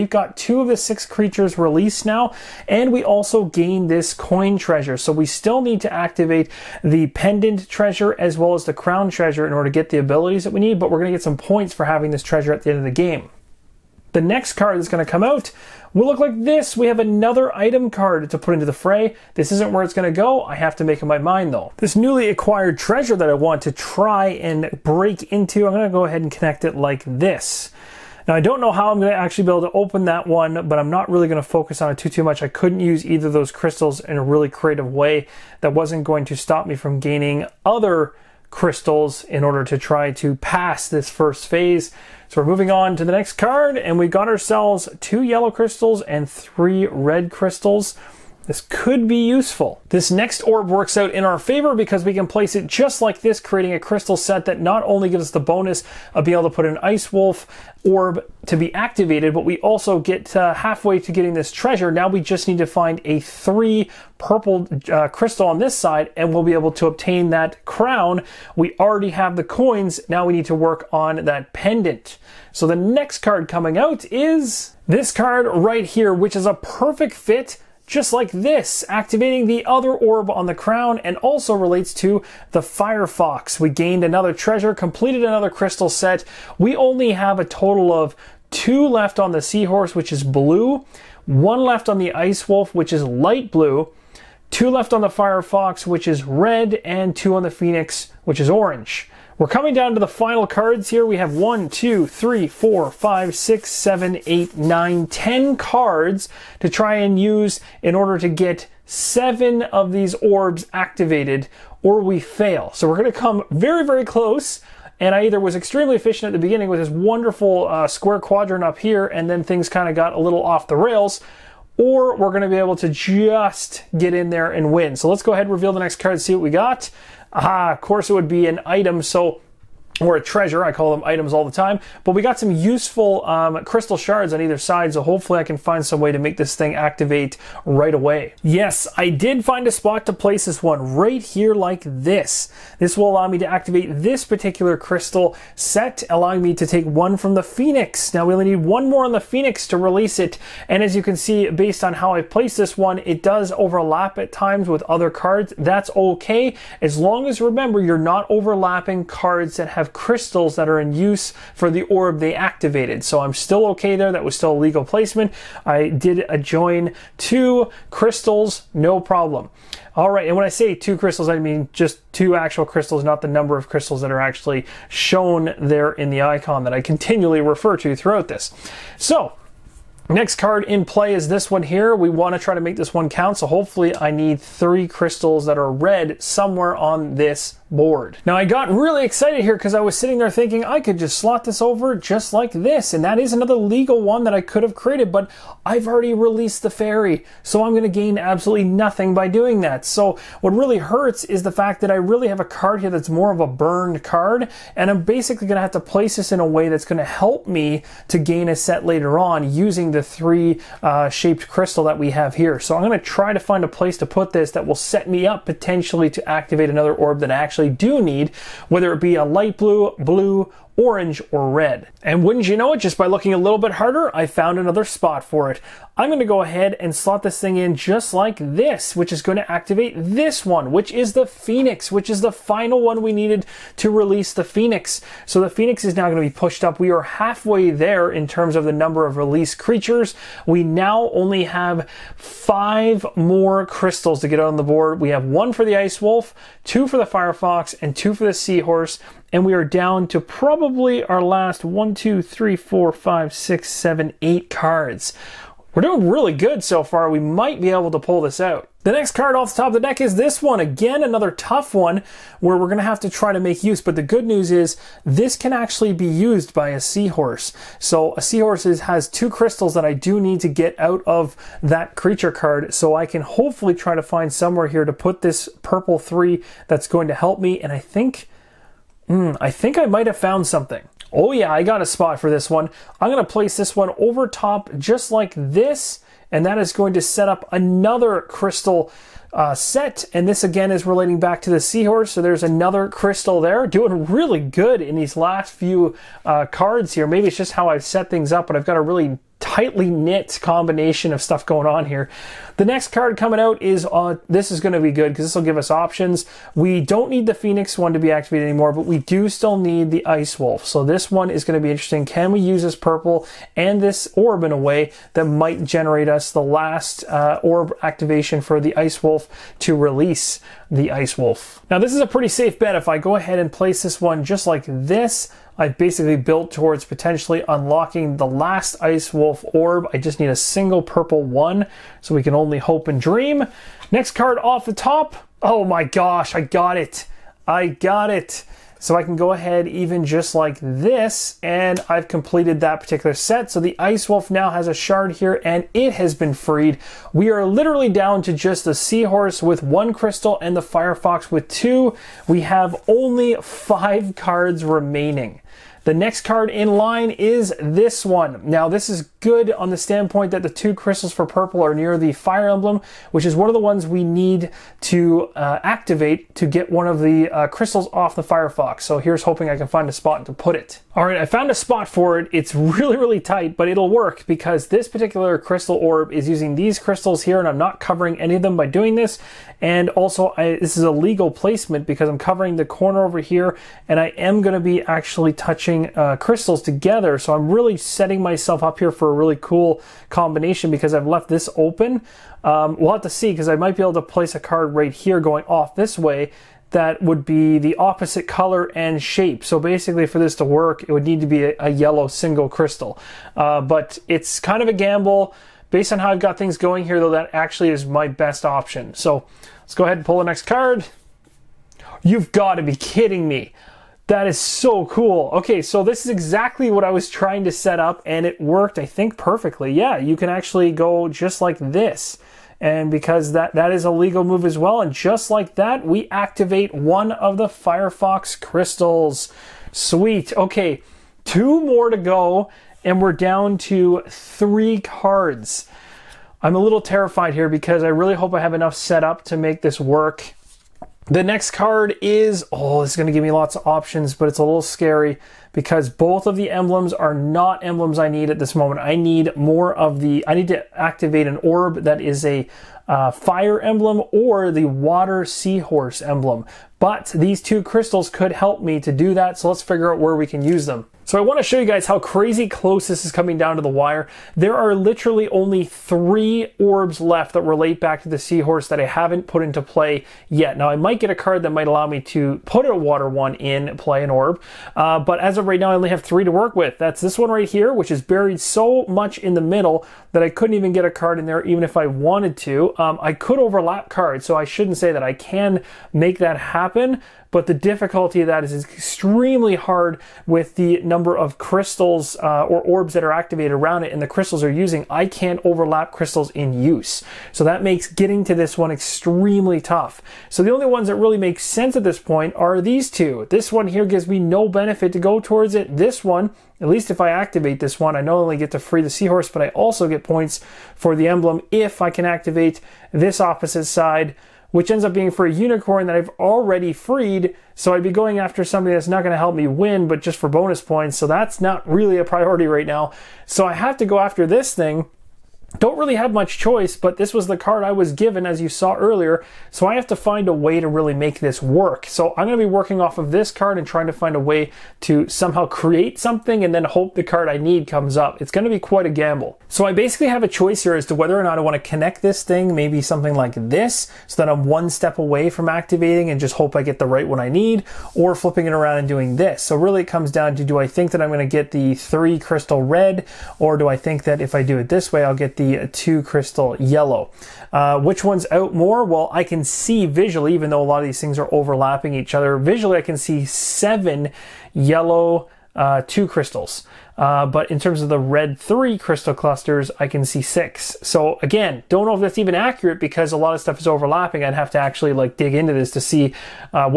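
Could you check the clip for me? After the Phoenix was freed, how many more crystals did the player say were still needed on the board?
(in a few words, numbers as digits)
5.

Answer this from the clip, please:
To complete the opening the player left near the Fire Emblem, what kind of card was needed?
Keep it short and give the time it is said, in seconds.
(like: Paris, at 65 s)
A yellow single crystal, at 401 s.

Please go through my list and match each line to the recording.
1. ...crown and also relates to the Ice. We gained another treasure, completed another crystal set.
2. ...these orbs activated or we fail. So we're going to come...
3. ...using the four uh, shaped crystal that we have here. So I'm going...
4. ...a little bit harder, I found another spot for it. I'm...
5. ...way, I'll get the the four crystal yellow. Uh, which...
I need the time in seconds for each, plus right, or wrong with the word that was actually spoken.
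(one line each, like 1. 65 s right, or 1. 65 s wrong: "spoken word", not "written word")
1. 80 s wrong: "Firefox", not "Ice"
2. 109 s right
3. 209 s wrong: "three", not "four"
4. 223 s right
5. 554 s wrong: "two", not "four".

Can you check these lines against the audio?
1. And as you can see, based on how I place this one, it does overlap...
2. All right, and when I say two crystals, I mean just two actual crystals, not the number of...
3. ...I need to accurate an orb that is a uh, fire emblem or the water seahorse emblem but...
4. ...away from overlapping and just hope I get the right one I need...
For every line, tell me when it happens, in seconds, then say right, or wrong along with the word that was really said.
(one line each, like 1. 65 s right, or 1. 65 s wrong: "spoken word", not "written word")
1. 150 s right
2. 169 s right
3. 450 s wrong: "activate", not "accurate"
4. 544 s wrong: "activating", not "overlapping".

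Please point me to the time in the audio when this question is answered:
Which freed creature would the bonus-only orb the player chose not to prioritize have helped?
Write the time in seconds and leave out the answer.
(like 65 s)
515 s.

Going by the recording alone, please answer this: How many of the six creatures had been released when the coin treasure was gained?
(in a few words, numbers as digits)
2.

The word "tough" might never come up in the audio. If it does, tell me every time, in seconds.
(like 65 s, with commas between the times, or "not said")
261 s, 499 s.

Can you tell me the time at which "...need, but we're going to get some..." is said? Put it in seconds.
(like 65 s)
10 s.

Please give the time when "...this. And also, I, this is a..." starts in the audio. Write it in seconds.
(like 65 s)
378 s.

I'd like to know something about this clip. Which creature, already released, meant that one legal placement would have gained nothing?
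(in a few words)
The fairy.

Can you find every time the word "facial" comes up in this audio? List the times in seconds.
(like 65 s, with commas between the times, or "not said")
not said.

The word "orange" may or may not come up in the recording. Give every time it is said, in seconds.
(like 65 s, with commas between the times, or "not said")
98 s, 220 s.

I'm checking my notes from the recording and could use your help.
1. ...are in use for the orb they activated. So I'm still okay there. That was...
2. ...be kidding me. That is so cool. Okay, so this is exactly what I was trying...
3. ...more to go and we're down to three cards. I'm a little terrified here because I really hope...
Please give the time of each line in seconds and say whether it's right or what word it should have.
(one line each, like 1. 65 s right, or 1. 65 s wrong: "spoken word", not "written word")
1. 160 s right
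2. 412 s right
3. 431 s right.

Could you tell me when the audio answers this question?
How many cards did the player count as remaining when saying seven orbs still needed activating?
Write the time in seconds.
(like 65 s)
105 s.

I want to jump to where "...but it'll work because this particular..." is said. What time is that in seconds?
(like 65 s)
373 s.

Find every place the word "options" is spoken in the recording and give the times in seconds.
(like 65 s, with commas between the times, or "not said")
305 s, 408 s, 443 s.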